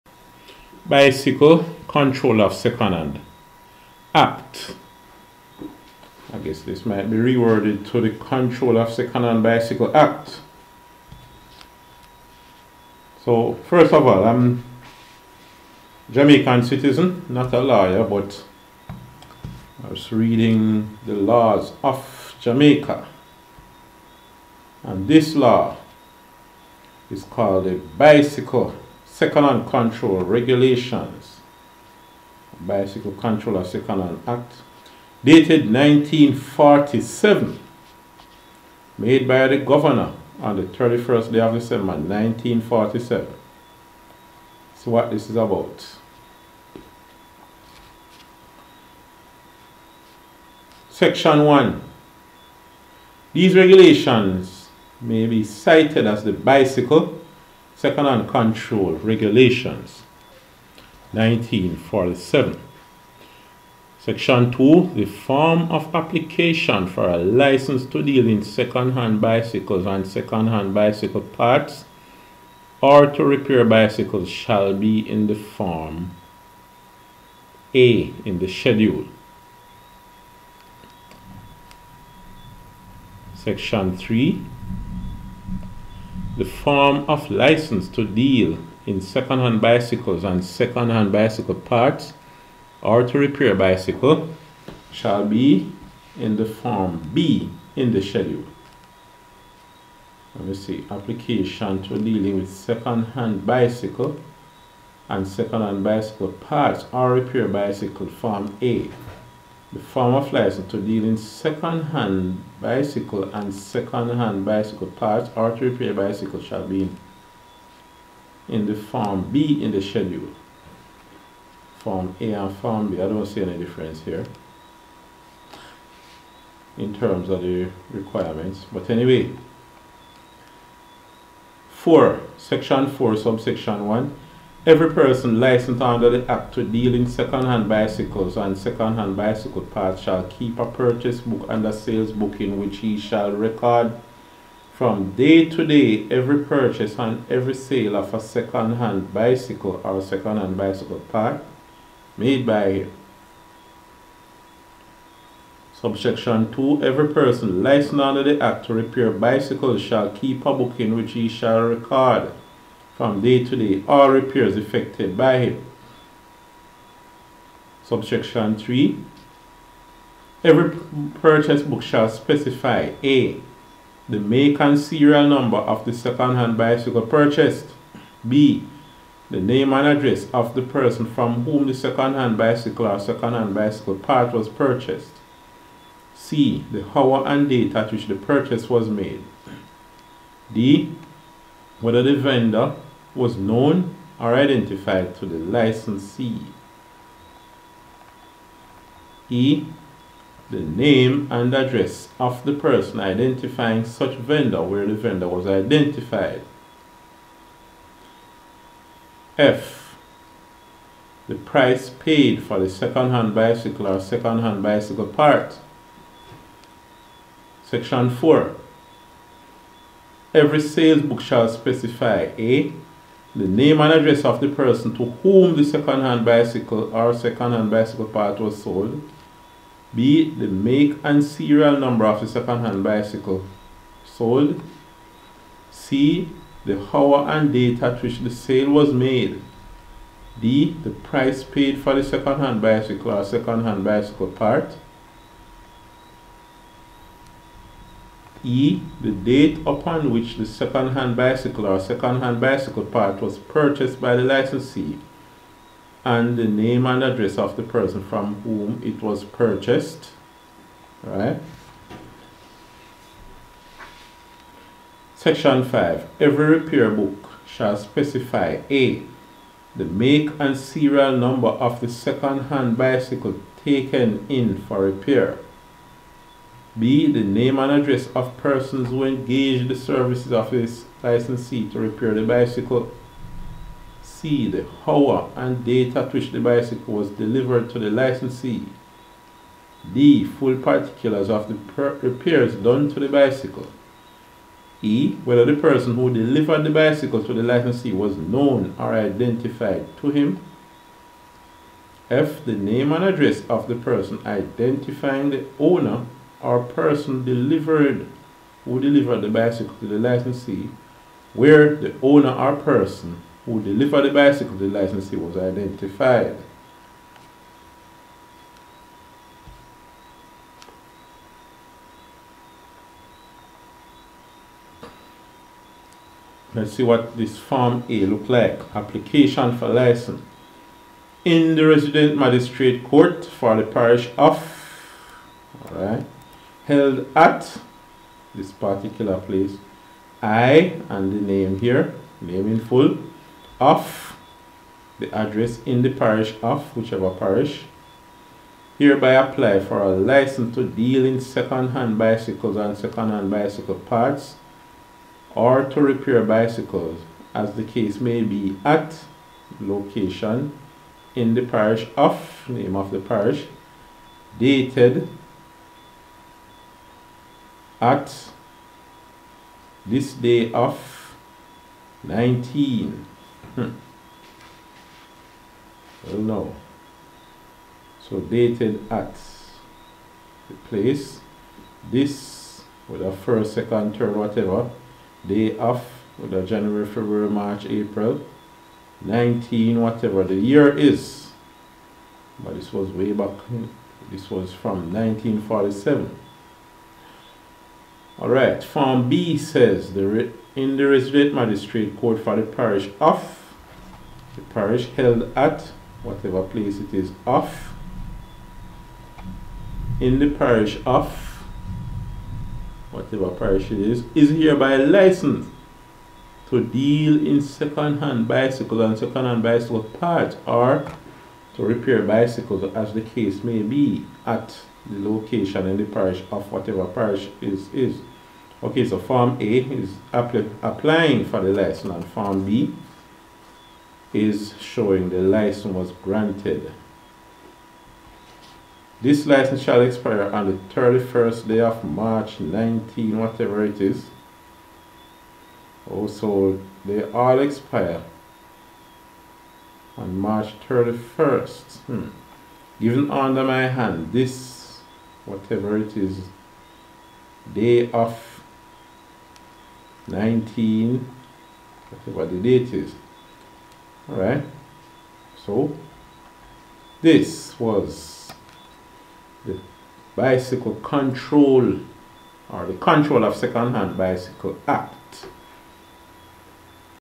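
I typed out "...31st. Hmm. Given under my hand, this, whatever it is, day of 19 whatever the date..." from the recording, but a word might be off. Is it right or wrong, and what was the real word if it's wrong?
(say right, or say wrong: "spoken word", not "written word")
right.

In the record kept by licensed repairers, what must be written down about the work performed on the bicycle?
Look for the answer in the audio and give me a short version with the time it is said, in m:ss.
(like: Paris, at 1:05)
Full particulars, at 4:50.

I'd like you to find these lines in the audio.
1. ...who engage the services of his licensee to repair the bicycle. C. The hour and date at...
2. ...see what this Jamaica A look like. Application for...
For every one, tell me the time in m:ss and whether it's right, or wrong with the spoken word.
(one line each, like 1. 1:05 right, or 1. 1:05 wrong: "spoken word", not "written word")
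1. 4:38 right
2. 5:26 wrong: "Form", not "Jamaica".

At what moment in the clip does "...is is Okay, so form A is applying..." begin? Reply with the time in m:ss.
7:07.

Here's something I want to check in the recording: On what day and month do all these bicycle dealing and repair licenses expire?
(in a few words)
31st March.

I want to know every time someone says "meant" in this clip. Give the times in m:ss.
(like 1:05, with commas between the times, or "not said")
not said.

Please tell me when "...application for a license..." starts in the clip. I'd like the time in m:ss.
1:05.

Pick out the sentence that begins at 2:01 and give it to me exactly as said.
Form A and form B, I don't see any difference here in terms of the requirements.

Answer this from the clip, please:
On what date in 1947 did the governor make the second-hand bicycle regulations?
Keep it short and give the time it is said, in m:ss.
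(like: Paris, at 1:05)
31st December, at 0:40.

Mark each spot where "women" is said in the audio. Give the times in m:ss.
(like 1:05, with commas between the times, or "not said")
not said.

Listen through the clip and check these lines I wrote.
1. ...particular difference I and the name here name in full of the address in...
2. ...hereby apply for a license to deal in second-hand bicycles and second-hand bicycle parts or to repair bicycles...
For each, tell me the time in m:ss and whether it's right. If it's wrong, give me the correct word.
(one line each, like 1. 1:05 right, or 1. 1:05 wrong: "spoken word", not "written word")
1. 5:38 wrong: "place", not "difference"
2. 5:48 right.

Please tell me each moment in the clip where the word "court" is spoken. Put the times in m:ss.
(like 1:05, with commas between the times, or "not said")
5:32, 6:41.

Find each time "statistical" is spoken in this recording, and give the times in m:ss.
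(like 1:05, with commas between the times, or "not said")
not said.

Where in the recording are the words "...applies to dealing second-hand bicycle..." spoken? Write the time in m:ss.
1:50.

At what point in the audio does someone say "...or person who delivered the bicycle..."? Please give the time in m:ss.
5:12.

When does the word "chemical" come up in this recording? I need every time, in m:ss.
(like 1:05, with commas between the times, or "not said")
not said.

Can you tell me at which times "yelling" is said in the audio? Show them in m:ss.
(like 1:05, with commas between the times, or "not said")
not said.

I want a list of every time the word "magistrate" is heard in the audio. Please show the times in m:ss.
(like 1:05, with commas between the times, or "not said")
5:32, 6:41.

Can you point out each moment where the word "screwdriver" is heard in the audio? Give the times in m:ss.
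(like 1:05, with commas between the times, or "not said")
not said.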